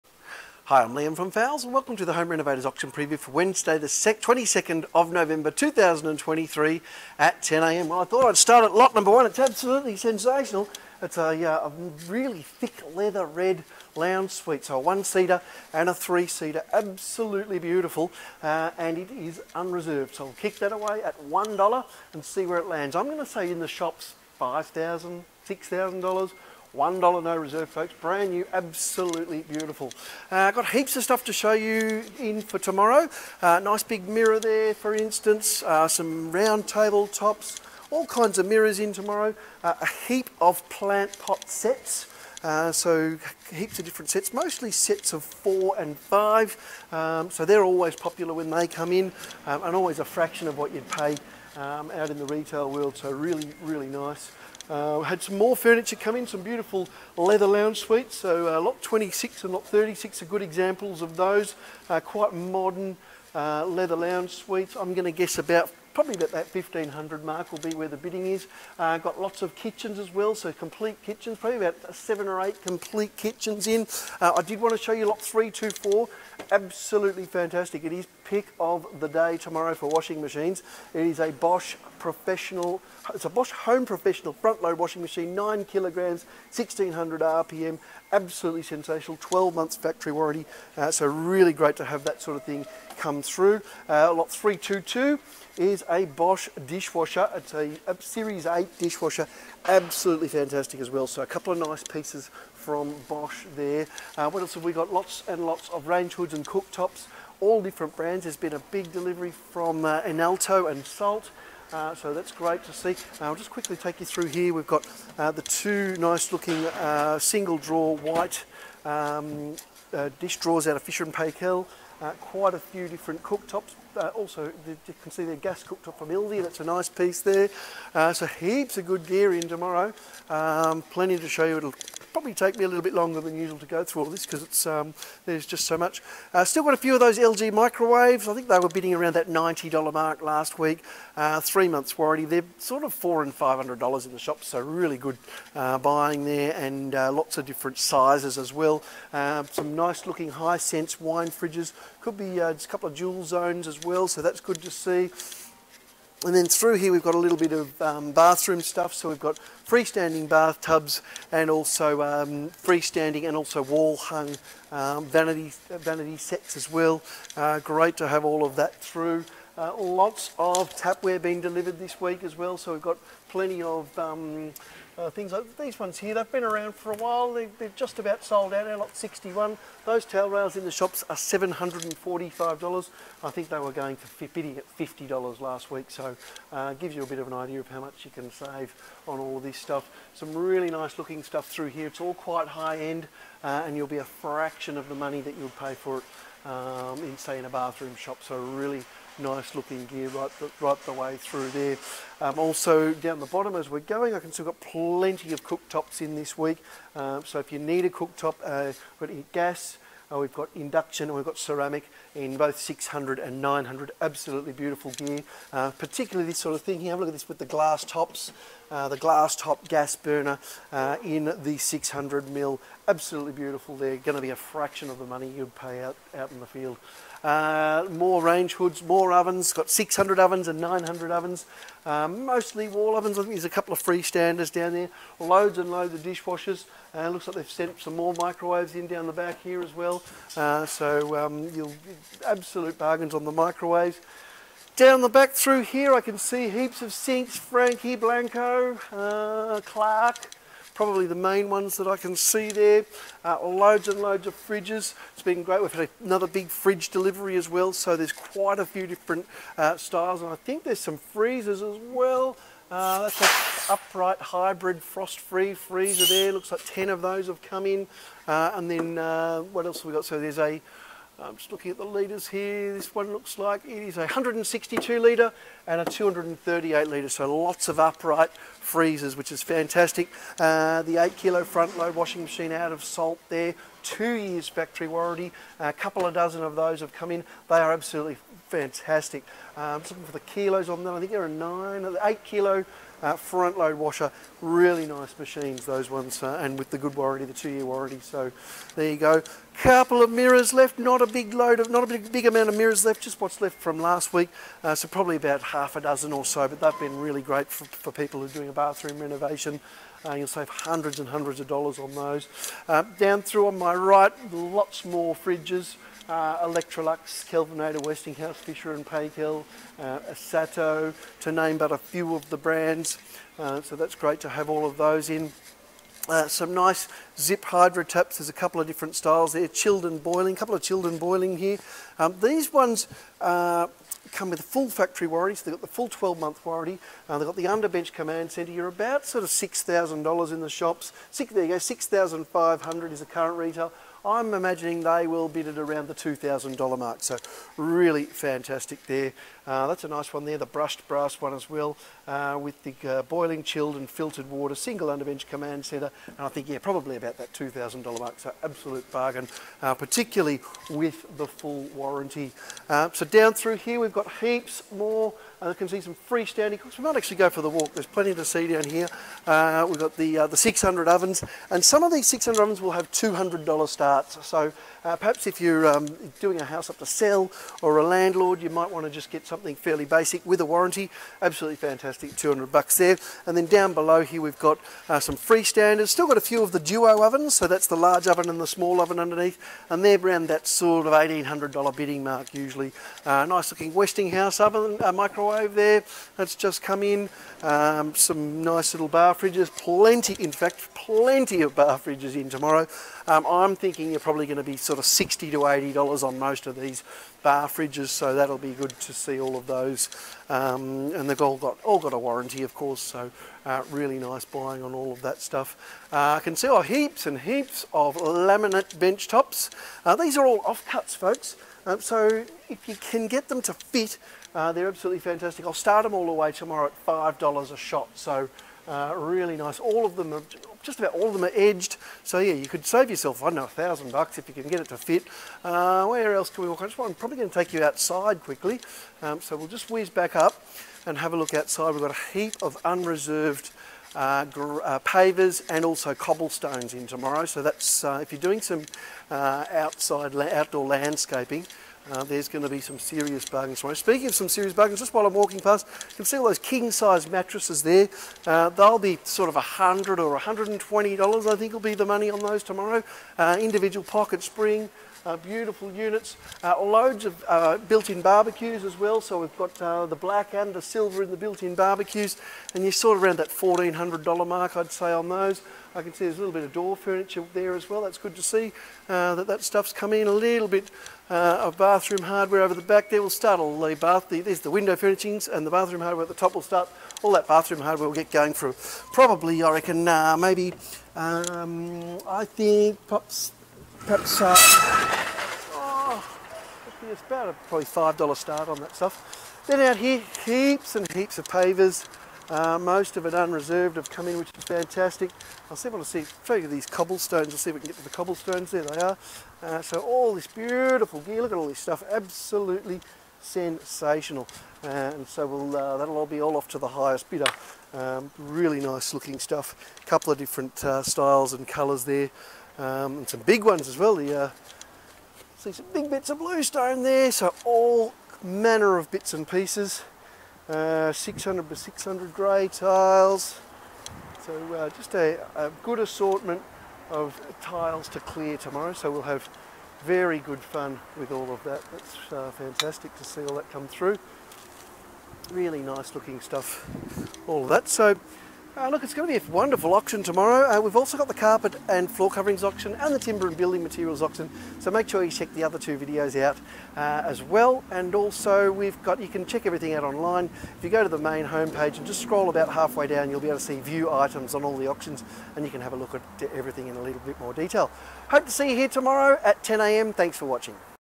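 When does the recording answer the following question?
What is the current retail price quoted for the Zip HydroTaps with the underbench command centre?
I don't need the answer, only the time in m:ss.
5:41.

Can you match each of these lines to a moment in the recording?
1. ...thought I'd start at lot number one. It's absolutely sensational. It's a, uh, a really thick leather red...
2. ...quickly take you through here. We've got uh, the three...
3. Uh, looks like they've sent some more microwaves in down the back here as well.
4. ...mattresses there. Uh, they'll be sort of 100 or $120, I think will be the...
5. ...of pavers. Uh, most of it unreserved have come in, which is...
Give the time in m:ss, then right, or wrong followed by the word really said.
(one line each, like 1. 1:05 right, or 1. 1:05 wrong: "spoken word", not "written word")
1. 0:08 right
2. 1:53 wrong: "two", not "three"
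3. 3:56 right
4. 7:37 right
5. 8:21 right.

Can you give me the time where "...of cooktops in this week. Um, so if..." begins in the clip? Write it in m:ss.
3:25.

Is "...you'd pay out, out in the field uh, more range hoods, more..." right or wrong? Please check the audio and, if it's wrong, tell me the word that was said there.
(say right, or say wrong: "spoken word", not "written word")
right.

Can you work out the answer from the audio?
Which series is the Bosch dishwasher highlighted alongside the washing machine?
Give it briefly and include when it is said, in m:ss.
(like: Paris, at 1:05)
Series 8, at 1:38.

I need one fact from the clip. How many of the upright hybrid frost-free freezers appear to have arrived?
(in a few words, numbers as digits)
10.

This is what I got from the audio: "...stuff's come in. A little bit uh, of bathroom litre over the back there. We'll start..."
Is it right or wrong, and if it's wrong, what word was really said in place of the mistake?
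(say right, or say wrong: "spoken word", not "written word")
wrong: "hardware", not "litre".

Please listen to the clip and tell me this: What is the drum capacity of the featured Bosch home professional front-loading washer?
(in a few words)
9 kilograms.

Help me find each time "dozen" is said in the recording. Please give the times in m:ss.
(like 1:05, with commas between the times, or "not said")
4:46, 5:05.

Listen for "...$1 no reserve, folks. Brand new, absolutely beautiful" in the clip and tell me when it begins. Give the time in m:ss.
0:26.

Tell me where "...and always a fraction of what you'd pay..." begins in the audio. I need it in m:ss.
0:49.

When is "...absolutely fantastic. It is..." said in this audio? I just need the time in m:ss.
1:16.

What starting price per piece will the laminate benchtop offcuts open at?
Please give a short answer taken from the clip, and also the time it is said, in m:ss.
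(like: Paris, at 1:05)
$5, at 7:06.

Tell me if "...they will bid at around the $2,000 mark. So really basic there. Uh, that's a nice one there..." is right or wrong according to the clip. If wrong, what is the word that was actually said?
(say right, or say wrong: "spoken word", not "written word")
wrong: "fantastic", not "basic".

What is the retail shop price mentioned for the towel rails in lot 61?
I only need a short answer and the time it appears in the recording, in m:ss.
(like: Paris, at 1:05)
$745, at 3:01.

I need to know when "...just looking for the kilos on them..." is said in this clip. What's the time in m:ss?
4:49.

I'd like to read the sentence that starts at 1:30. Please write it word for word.
Uh, so really great to have that sort of thing come through.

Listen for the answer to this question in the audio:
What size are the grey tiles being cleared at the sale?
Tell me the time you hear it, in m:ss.
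8:50.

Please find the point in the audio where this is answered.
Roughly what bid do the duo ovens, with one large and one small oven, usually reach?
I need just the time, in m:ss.
6:30.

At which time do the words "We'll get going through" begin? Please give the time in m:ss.
8:07.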